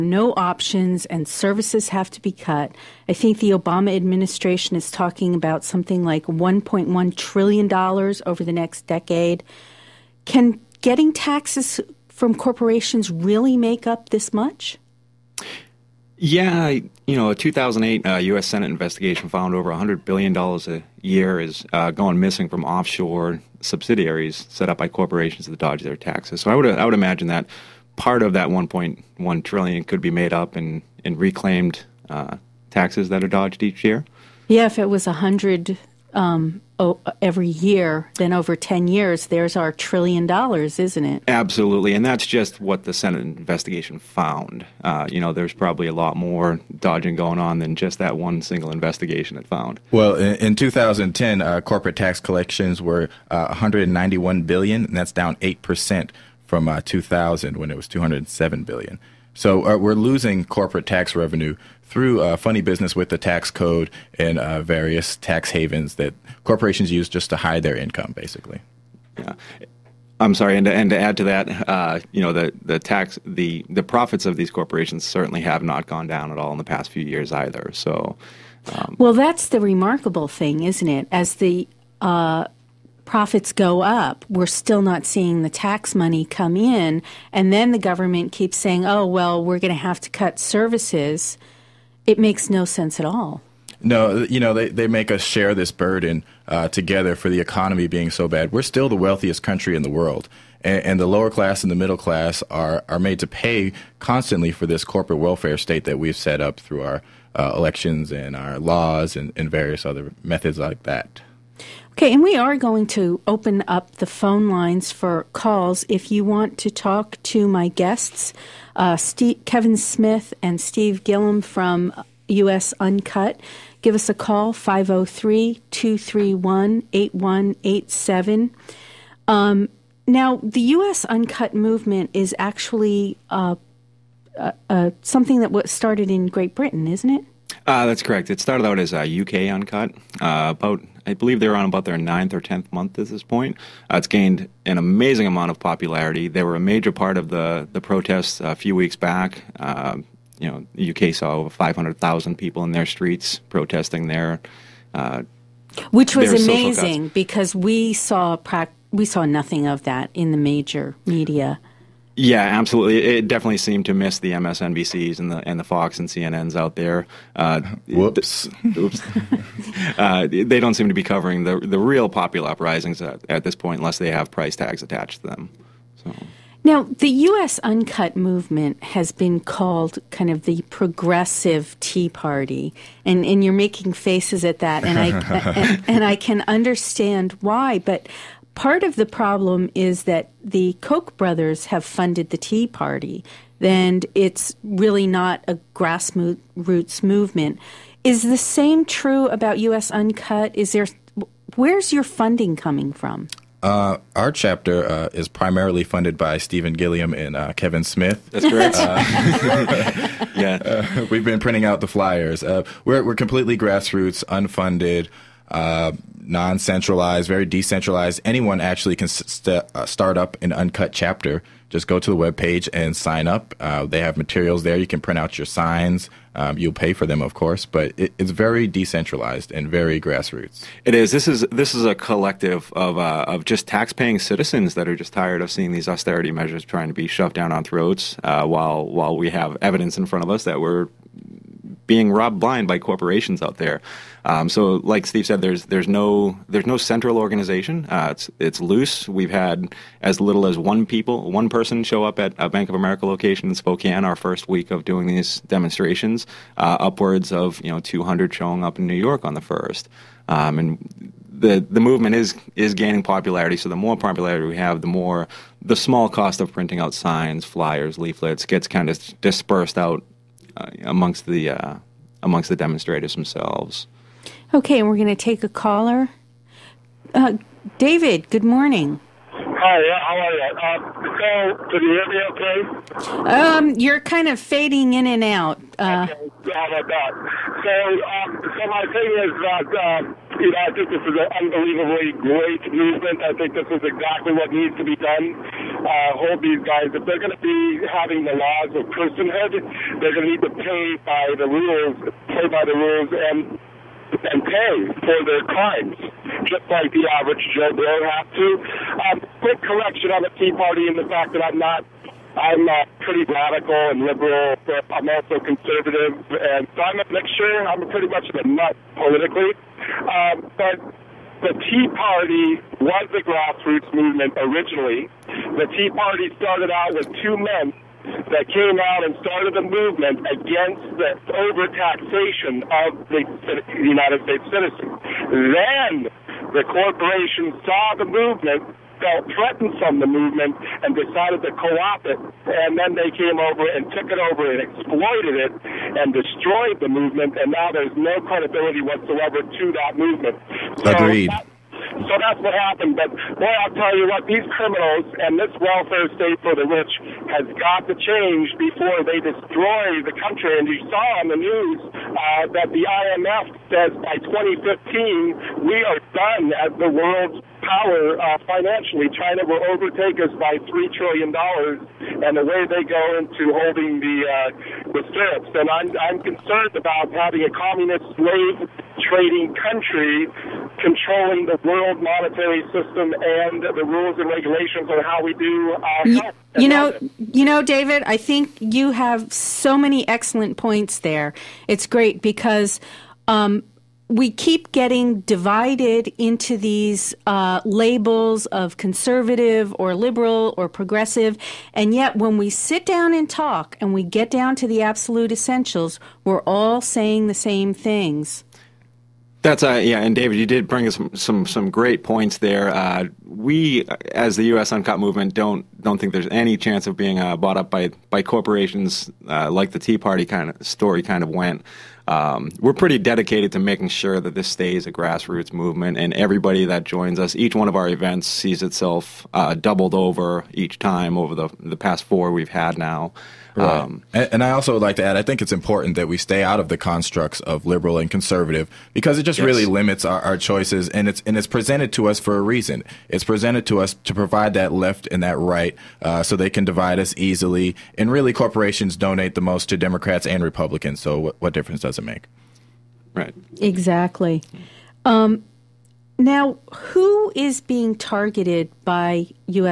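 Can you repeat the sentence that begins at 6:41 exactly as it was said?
And yet, when we sit down and talk and we get down to the absolute essentials, we're all saying the same things.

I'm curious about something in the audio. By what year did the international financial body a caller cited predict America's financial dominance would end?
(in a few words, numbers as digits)
2015.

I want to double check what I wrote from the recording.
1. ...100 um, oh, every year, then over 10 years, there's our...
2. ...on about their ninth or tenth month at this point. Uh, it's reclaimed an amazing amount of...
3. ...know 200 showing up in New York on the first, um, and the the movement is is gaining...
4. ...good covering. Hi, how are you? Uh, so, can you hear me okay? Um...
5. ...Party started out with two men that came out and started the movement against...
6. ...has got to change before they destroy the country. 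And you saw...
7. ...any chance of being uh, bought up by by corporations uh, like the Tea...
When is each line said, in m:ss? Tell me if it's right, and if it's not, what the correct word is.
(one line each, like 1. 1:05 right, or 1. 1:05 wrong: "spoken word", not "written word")
1. 0:35 right
2. 2:21 wrong: "gained", not "reclaimed"
3. 4:17 right
4. 4:38 wrong: "morning", not "covering"
5. 5:25 right
6. 5:57 right
7. 6:56 right.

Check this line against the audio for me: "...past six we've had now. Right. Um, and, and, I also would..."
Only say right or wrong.
wrong.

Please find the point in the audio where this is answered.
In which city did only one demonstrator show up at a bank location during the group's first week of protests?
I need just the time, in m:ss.
4:13.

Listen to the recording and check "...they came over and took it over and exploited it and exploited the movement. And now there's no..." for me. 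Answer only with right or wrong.
wrong.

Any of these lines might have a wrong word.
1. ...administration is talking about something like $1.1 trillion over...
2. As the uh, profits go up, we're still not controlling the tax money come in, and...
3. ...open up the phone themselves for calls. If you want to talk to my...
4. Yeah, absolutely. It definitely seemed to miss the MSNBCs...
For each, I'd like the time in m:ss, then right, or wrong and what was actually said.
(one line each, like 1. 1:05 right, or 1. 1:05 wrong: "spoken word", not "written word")
1. 0:03 right
2. 1:21 wrong: "seeing", not "controlling"
3. 1:53 wrong: "lines", not "themselves"
4. 2:42 right.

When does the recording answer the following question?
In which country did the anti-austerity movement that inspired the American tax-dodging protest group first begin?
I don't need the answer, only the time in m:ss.
2:16.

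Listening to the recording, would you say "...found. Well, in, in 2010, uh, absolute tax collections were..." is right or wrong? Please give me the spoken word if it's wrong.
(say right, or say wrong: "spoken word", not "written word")
wrong: "corporate", not "absolute".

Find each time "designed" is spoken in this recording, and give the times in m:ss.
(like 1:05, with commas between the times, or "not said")
not said.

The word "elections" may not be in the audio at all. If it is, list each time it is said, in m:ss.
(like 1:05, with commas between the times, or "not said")
1:47.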